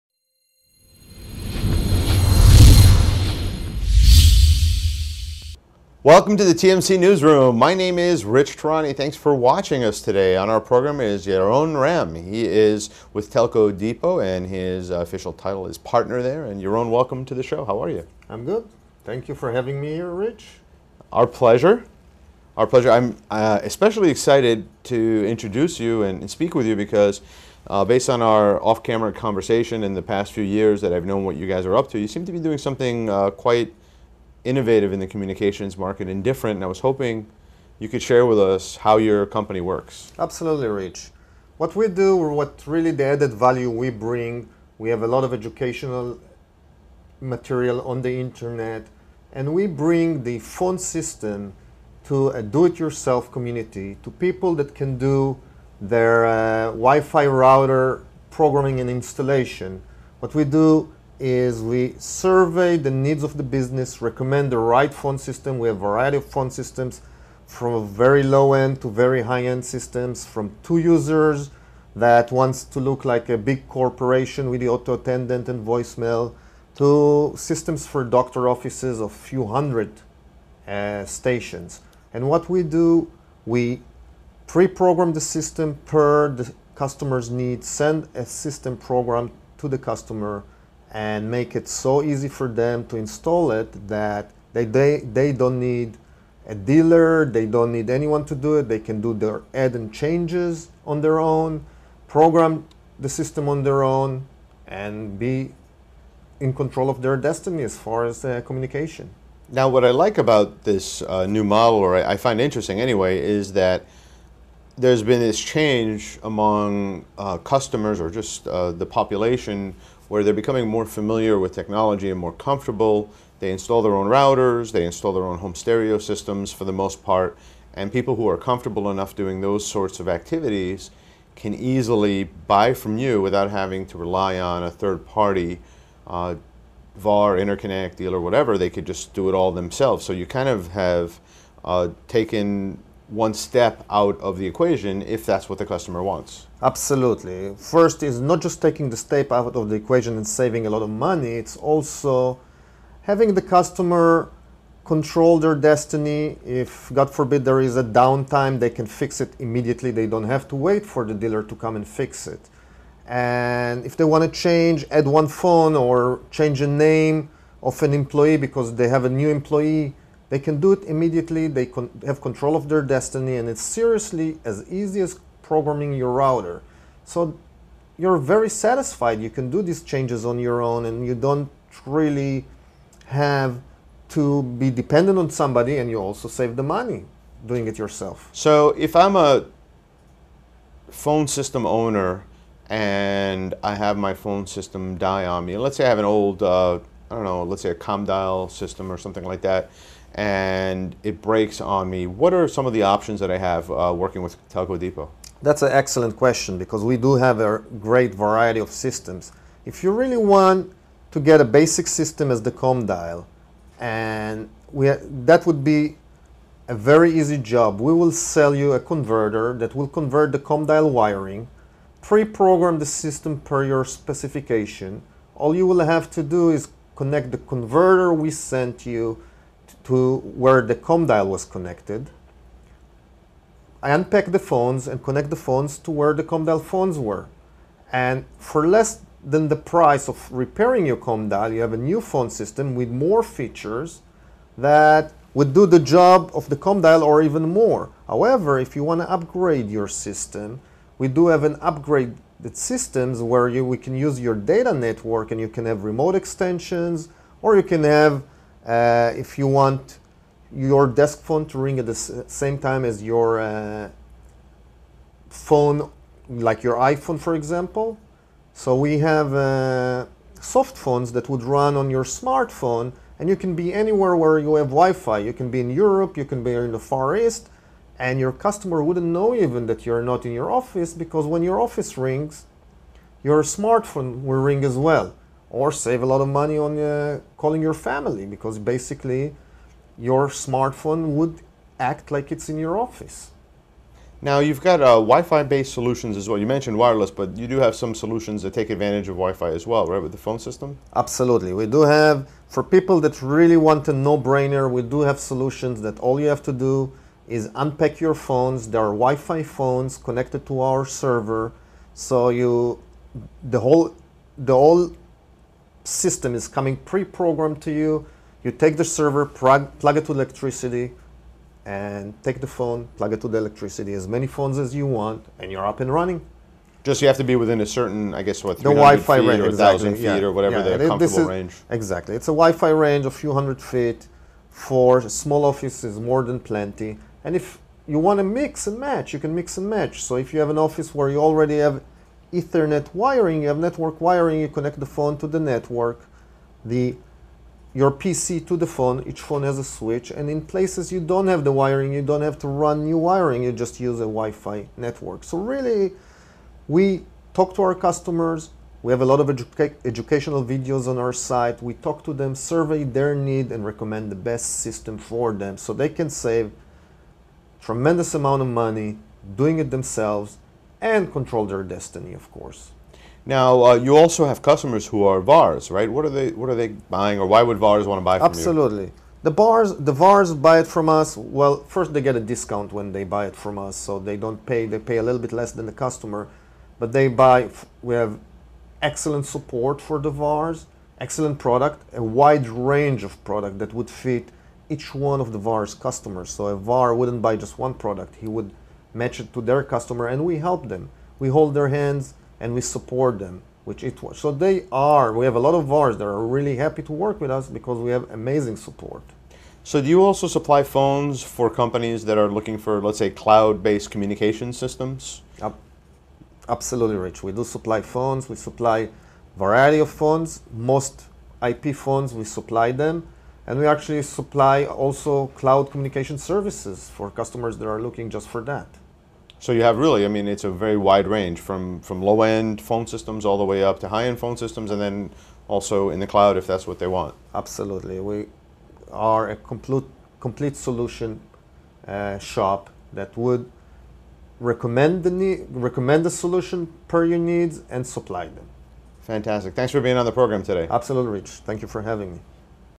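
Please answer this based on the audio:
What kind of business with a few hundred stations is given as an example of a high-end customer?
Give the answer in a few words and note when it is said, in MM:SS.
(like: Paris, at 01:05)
Doctor offices, at 01:18.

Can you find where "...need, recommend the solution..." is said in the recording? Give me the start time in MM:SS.
07:25.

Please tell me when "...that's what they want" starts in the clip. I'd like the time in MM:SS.
07:16.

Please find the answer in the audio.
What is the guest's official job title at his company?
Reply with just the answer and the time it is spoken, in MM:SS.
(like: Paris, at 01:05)
Partner, at 00:15.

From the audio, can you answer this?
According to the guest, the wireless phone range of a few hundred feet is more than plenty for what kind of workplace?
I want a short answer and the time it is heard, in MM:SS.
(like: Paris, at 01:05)
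Small offices, at 05:35.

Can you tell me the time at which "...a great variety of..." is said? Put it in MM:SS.
03:27.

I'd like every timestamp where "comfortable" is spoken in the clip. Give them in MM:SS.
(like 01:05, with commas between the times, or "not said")
02:02, 02:08, 05:30.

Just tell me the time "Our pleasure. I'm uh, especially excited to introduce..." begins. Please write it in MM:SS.
00:22.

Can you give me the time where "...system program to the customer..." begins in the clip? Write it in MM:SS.
01:28.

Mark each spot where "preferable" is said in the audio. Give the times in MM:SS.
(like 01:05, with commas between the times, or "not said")
not said.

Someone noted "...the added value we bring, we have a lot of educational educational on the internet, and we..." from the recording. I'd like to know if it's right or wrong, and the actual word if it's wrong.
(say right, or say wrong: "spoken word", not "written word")
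wrong: "material", not "educational".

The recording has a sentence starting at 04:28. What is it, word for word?
So we have uh, soft phones that would run on your smartphone, and you can be anywhere where you have Wi-Fi.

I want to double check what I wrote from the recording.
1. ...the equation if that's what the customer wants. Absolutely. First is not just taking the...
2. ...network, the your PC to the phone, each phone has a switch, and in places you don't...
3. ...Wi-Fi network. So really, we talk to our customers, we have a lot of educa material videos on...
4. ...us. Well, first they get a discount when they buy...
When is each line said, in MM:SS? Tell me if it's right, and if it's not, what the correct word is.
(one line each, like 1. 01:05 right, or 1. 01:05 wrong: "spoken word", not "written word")
1. 02:24 right
2. 05:45 right
3. 05:54 wrong: "educational", not "material"
4. 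06:20 right.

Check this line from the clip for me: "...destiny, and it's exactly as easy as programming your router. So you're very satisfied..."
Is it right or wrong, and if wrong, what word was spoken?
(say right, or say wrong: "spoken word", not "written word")
wrong: "seriously", not "exactly".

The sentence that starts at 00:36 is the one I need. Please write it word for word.
And I was hoping you could share with us how your company works.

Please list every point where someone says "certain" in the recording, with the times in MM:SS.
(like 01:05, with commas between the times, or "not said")
05:27.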